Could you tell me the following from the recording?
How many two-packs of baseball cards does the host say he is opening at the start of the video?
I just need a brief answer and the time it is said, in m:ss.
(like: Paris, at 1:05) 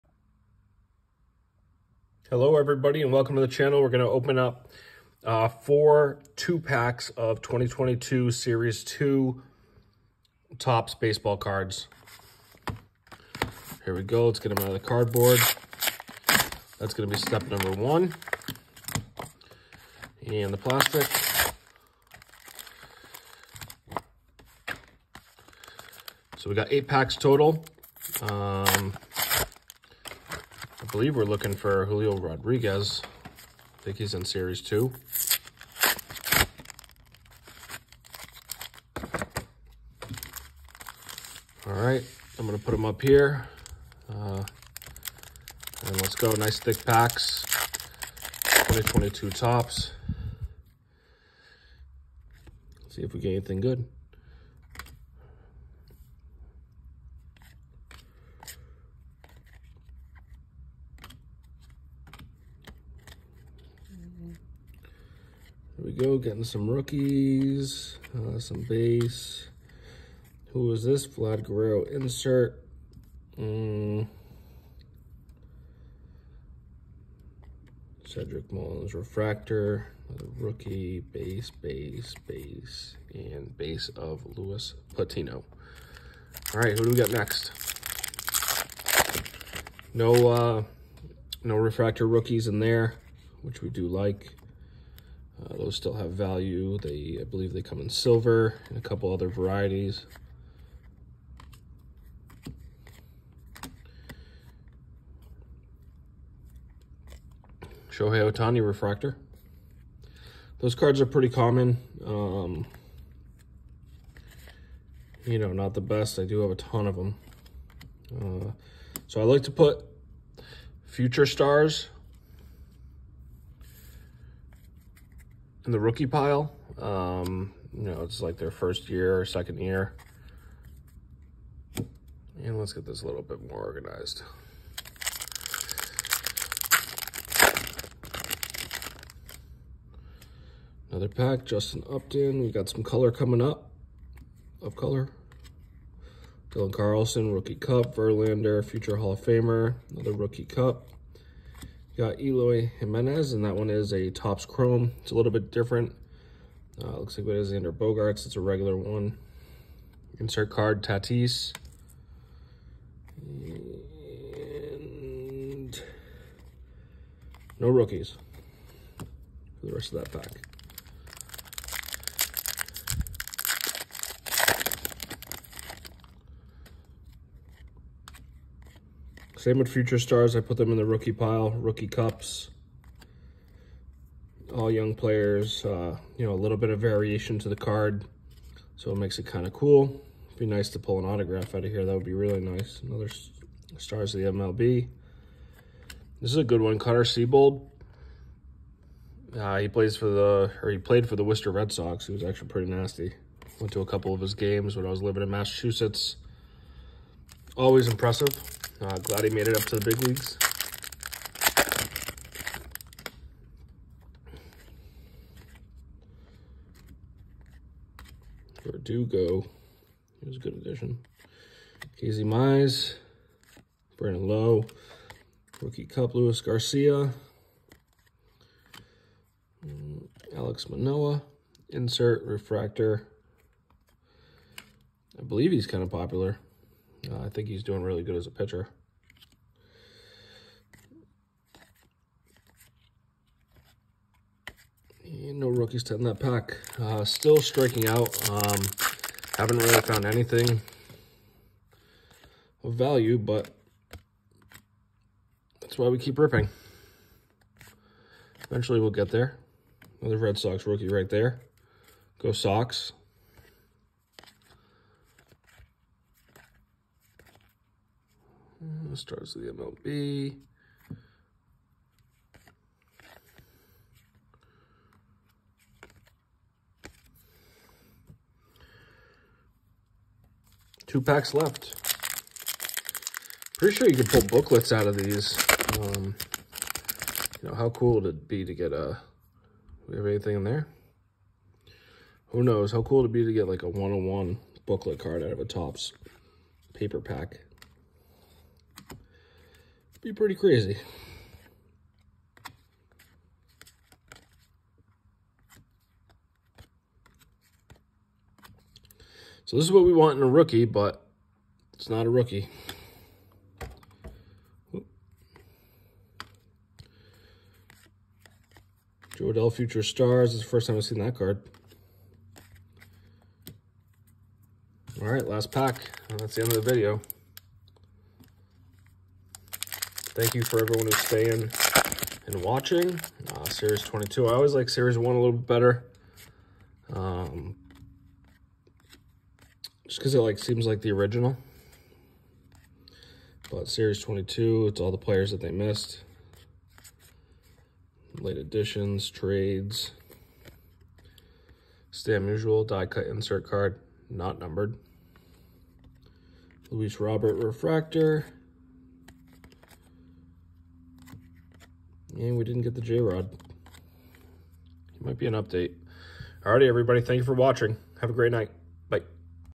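4, at 0:05.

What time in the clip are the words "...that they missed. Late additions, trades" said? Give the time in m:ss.
5:45.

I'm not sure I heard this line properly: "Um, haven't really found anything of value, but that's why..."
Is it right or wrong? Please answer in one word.
right.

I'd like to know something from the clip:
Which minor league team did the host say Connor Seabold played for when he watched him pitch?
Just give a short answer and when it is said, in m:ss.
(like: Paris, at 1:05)
Worcester Red Sox, at 3:21.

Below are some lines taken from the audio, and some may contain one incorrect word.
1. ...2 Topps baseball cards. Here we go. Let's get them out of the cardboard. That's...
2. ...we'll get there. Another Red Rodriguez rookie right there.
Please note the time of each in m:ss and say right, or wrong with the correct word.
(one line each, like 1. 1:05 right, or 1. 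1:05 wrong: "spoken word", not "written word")
1. 0:08 right
2. 4:18 wrong: "Sox", not "Rodriguez".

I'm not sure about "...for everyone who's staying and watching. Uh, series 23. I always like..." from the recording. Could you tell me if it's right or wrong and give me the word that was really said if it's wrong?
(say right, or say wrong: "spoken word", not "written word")
wrong: "22", not "23".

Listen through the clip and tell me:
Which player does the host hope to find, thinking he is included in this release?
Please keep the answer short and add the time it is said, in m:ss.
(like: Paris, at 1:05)
Julio Rodriguez, at 0:31.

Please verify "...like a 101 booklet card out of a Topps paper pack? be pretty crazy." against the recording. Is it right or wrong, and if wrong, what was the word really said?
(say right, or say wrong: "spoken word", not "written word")
right.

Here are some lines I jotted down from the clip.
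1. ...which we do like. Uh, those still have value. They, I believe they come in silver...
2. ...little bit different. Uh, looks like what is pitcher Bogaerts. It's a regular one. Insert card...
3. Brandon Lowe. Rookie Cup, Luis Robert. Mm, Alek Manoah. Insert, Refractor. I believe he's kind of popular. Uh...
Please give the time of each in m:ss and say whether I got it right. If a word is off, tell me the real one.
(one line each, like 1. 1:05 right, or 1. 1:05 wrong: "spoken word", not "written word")
1. 1:33 right
2. 2:35 wrong: "under", not "pitcher"
3. 3:43 wrong: "Garcia", not "Robert".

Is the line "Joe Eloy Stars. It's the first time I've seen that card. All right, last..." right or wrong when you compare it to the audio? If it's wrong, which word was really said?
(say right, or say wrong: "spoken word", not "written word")
wrong: "Future", not "Eloy".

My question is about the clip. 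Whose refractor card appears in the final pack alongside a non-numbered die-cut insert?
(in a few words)
Luis Robert.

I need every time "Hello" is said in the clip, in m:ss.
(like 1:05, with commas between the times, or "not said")
0:02.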